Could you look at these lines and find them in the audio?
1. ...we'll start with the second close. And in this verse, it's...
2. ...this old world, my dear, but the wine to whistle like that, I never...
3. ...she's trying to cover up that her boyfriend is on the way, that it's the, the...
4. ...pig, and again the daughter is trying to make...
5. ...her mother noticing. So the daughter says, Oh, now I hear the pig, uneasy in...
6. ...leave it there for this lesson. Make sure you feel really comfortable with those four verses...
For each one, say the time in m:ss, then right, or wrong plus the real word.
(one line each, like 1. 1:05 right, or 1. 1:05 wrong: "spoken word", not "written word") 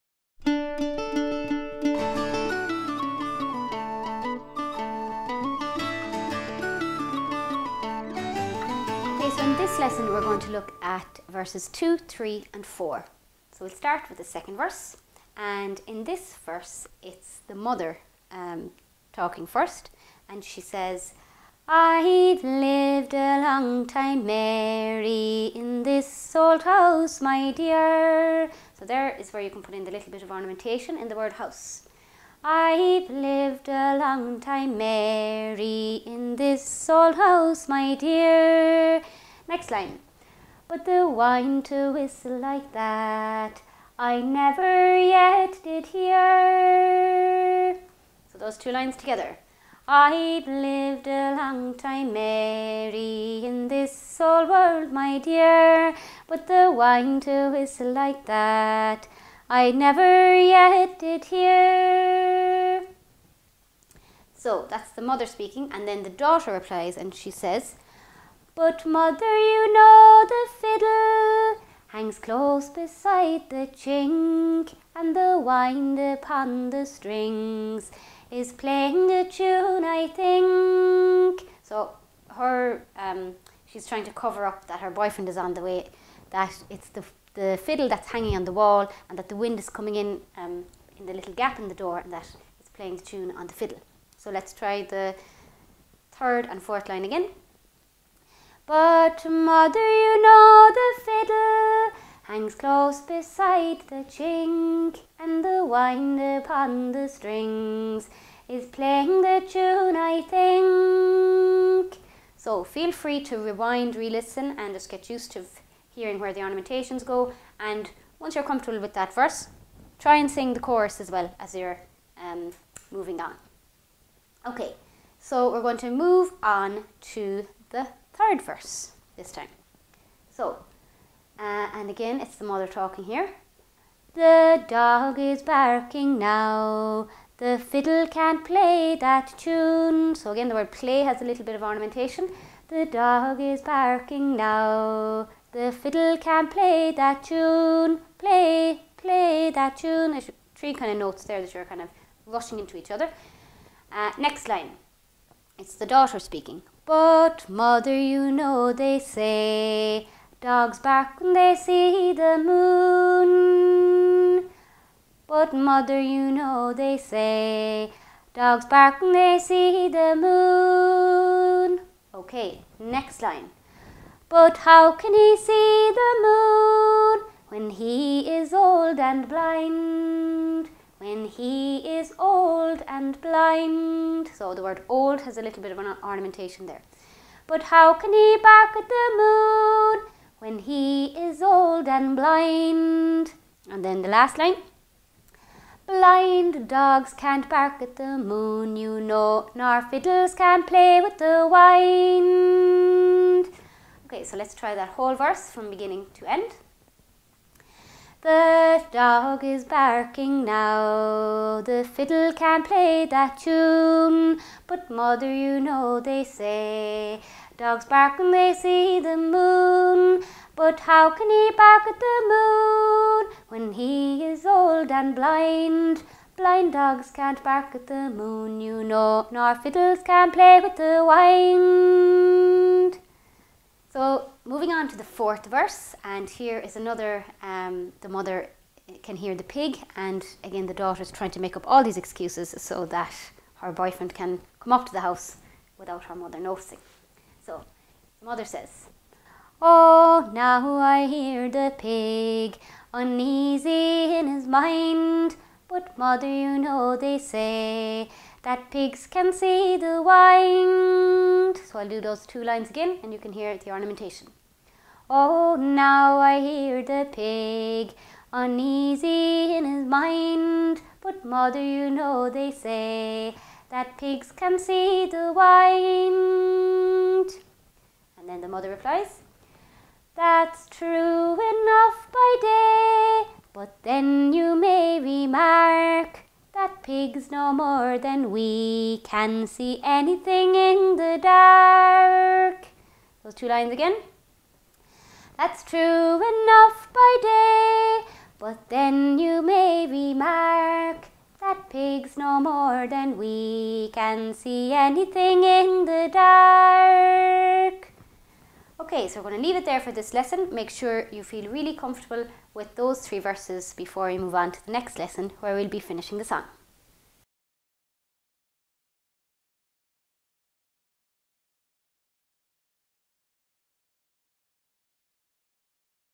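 1. 0:13 wrong: "verse", not "close"
2. 0:53 right
3. 1:23 right
4. 3:59 right
5. 4:06 wrong: "mother", not "daughter"
6. 5:09 wrong: "three", not "four".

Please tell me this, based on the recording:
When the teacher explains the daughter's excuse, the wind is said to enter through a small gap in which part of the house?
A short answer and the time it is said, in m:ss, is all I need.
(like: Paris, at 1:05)
door, at 1:31.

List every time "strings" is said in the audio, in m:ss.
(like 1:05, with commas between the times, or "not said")
1:16, 1:47.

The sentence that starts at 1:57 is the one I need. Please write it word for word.
And once you're comfortable with that verse, try and sing the chorus as well as you're um, moving on.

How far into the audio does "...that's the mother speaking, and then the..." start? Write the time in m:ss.
1:04.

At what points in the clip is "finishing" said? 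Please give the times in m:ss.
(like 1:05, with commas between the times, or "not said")
5:15.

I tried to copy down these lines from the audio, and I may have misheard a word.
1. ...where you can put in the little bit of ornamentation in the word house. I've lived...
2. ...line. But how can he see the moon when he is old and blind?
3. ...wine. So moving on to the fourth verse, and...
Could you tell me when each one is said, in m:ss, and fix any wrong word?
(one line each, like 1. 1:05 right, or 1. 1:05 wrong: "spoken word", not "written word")
1. 0:29 right
2. 2:53 right
3. 3:51 right.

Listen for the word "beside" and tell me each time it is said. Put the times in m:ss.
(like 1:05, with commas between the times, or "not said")
1:12, 1:43.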